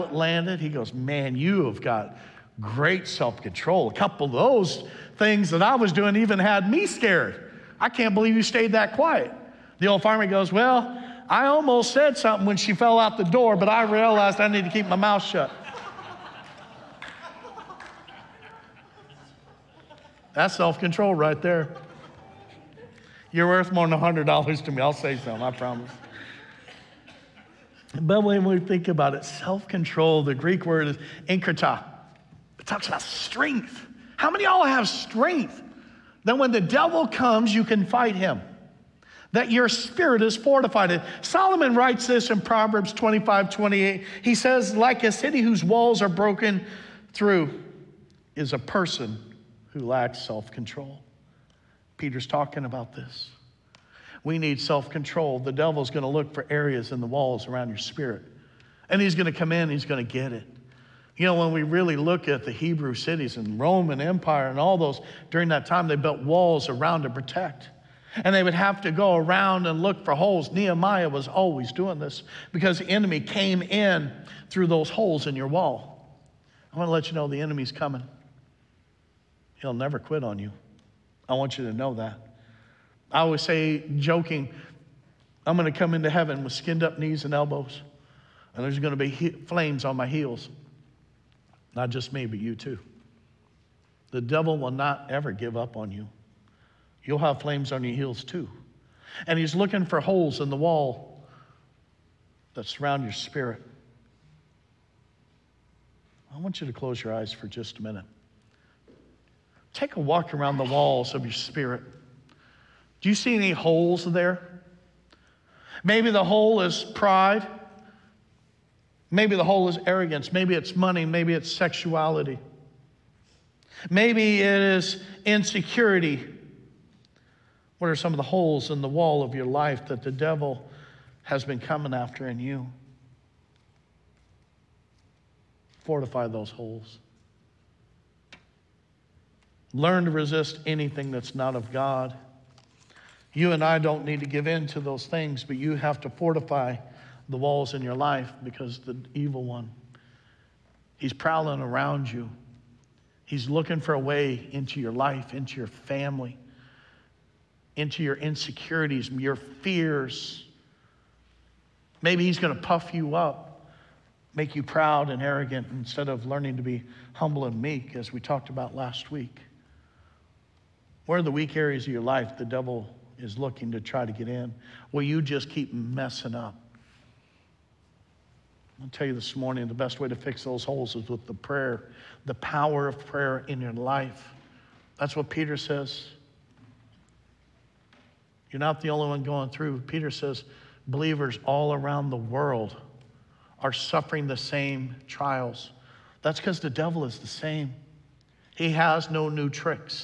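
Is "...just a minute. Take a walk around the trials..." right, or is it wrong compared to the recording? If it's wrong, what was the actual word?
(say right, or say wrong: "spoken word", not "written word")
wrong: "walls", not "trials".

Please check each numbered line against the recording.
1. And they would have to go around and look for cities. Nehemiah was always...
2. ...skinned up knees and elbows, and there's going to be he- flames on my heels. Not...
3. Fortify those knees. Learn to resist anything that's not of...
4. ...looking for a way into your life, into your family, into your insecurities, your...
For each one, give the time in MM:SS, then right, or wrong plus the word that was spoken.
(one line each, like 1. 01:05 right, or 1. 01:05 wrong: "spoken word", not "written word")
1. 01:08 wrong: "holes", not "cities"
2. 01:26 right
3. 02:15 wrong: "holes", not "knees"
4. 02:33 right.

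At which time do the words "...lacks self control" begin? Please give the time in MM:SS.
00:49.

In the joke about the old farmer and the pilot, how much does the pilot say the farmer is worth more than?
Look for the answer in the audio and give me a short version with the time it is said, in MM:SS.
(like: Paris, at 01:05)
$100, at 00:23.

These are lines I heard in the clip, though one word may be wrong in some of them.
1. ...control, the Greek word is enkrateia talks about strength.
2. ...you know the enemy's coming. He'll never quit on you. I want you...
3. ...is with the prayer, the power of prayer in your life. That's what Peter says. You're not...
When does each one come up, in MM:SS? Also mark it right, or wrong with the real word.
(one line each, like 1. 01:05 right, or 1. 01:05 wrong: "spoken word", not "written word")
1. 00:29 right
2. 01:17 right
3. 03:00 right.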